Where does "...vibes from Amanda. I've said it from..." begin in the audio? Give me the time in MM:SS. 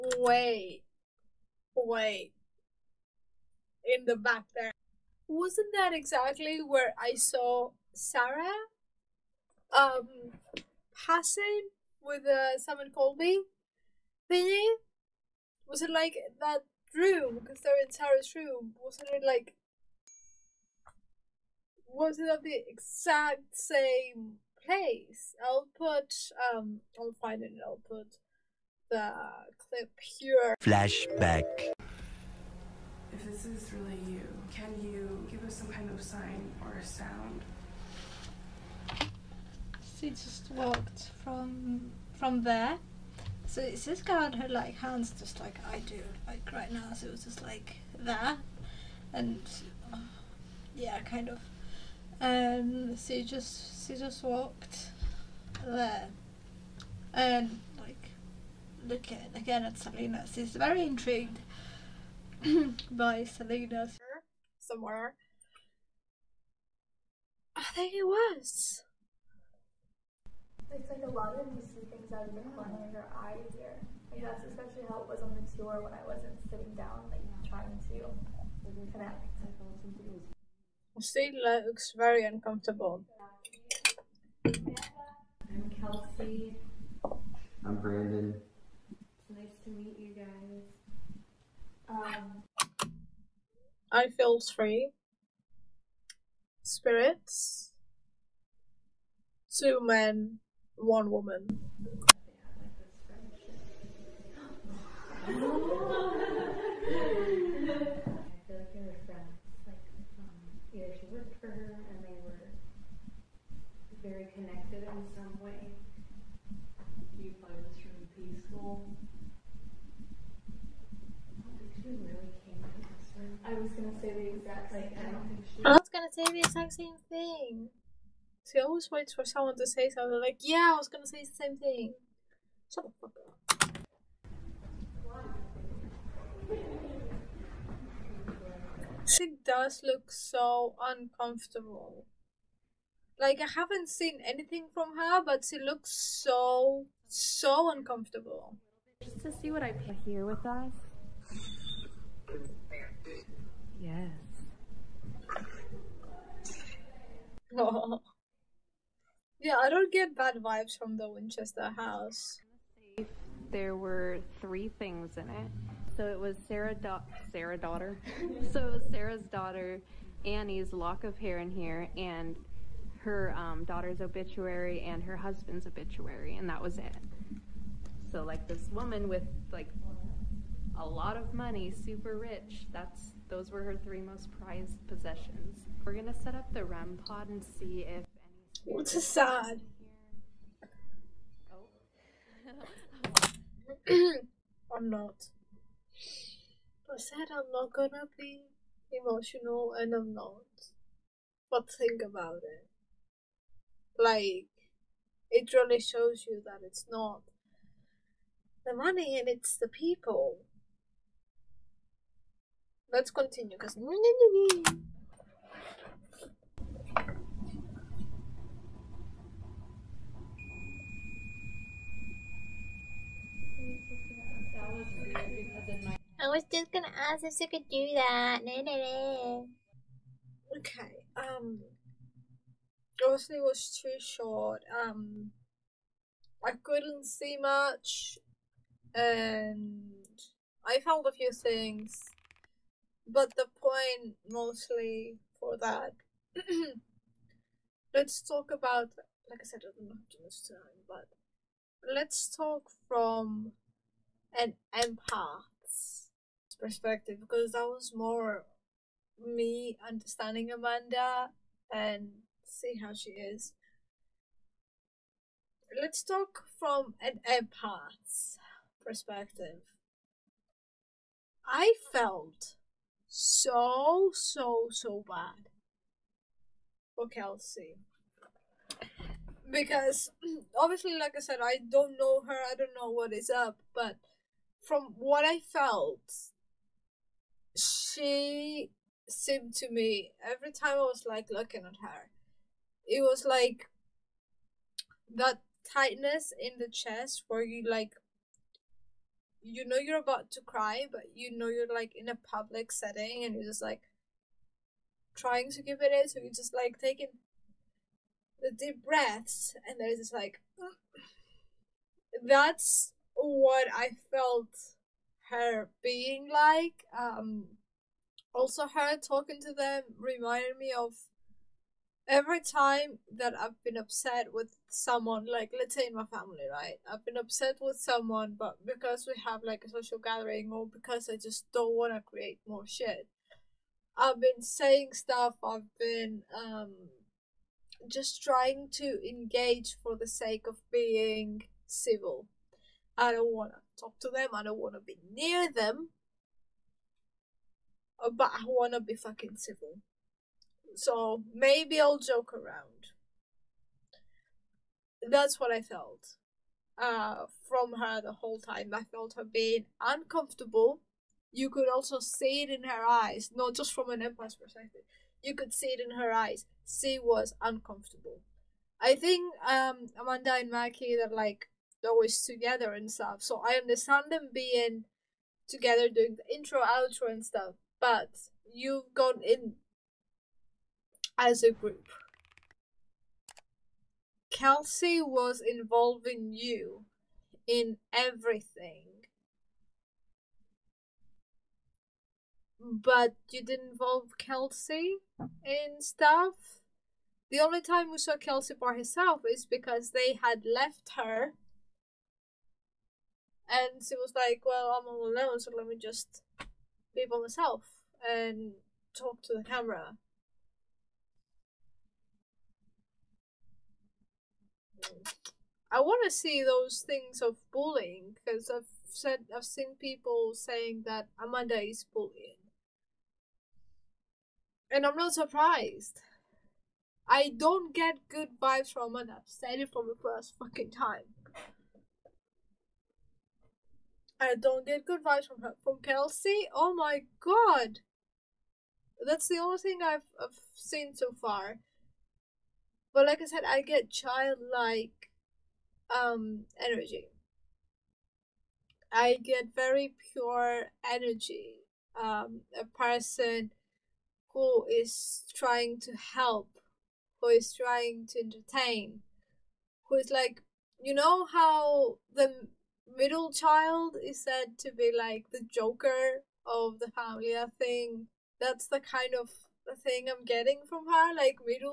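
07:08.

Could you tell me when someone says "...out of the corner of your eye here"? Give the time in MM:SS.
01:12.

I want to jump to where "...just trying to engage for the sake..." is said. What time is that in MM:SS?
05:37.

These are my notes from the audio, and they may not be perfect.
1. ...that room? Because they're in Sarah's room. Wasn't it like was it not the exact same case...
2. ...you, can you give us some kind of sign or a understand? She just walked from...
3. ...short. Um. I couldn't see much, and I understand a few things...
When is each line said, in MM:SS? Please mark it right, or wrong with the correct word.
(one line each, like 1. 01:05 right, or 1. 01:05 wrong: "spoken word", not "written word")
1. 00:16 right
2. 00:34 wrong: "sound", not "understand"
3. 03:53 wrong: "found", not "understand".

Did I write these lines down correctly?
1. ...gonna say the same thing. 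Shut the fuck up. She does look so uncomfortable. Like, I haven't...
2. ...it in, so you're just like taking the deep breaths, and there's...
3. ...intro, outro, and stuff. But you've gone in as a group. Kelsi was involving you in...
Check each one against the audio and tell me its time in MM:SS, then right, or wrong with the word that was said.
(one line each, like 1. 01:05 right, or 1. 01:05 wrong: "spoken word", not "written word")
1. 02:10 right
2. 05:05 right
3. 06:16 right.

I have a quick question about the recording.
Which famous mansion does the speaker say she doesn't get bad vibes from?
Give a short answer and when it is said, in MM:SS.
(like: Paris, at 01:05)
Winchester house, at 02:41.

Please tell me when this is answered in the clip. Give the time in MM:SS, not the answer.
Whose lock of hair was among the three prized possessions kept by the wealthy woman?
02:50.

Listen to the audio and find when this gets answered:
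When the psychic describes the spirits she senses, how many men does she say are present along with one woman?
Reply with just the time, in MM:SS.
01:39.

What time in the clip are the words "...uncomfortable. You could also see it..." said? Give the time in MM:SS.
05:59.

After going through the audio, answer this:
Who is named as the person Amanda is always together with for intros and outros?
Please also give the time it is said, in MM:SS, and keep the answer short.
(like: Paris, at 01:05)
Maki, at 06:10.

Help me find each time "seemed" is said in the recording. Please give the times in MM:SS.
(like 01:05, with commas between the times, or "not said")
04:49.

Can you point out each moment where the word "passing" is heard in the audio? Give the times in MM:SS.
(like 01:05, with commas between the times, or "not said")
00:11.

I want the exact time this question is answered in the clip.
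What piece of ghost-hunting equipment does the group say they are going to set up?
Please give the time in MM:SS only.
03:06.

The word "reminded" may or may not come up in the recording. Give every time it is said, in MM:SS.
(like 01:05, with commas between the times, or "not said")
05:19.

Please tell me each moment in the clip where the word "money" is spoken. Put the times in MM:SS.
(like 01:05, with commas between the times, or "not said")
03:01, 03:28.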